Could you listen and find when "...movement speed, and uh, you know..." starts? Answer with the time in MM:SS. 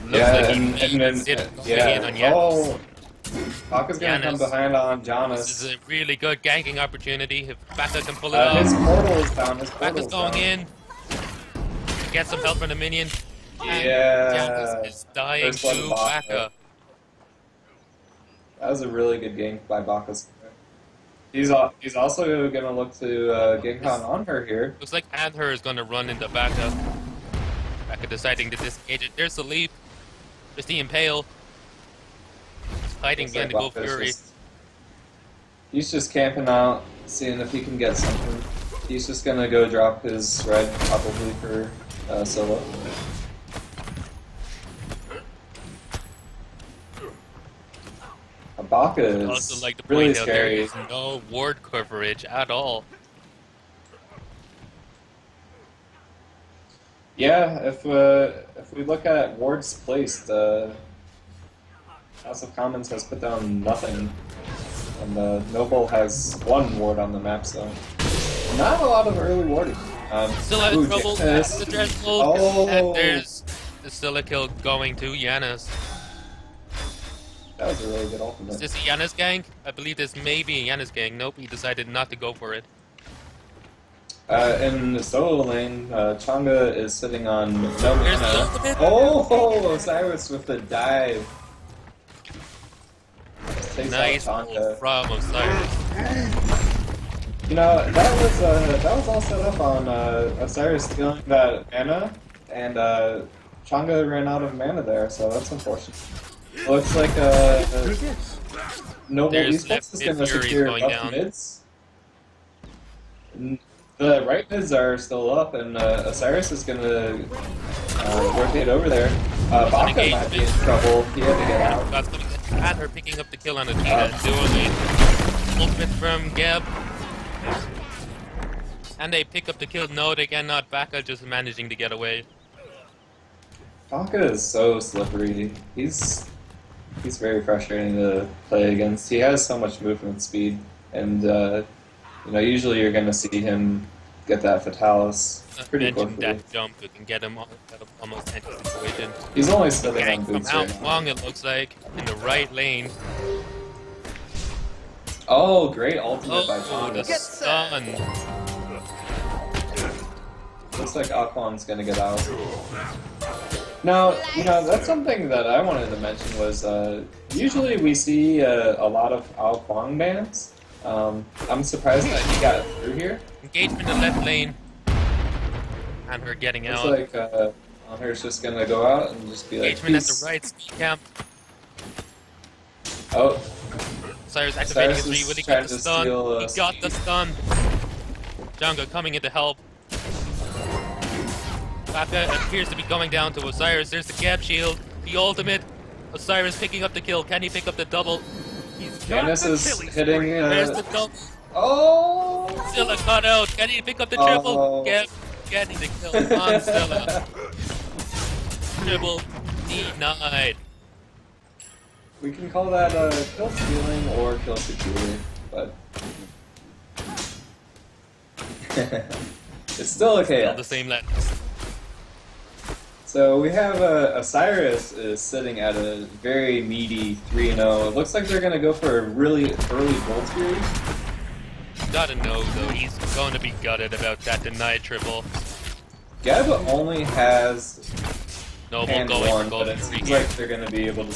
02:19.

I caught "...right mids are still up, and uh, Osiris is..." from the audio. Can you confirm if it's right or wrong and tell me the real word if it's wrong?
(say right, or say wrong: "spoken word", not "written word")
right.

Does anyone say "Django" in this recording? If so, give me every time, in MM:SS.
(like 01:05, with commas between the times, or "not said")
03:08.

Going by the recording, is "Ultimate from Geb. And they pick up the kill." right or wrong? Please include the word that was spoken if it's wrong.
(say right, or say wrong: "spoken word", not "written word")
right.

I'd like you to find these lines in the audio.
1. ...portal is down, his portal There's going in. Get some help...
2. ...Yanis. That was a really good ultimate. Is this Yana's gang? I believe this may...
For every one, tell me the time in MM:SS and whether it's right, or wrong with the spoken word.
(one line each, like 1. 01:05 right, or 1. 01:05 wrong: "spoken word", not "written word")
1. 00:08 wrong: "Baka", not "There"
2. 01:15 right.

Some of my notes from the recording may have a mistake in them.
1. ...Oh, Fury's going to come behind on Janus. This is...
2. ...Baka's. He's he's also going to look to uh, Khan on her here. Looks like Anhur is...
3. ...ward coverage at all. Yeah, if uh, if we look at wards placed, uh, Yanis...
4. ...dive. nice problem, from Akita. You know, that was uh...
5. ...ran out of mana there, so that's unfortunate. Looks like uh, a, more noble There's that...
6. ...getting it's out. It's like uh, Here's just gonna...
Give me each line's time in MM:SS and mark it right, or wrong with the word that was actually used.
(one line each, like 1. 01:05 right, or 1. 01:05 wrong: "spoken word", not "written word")
1. 00:02 wrong: "Baka", not "Fury"
2. 00:19 right
3. 00:51 wrong: "House", not "Yanis"
4. 01:30 wrong: "Osiris", not "Akita"
5. 01:44 right
6. 02:56 right.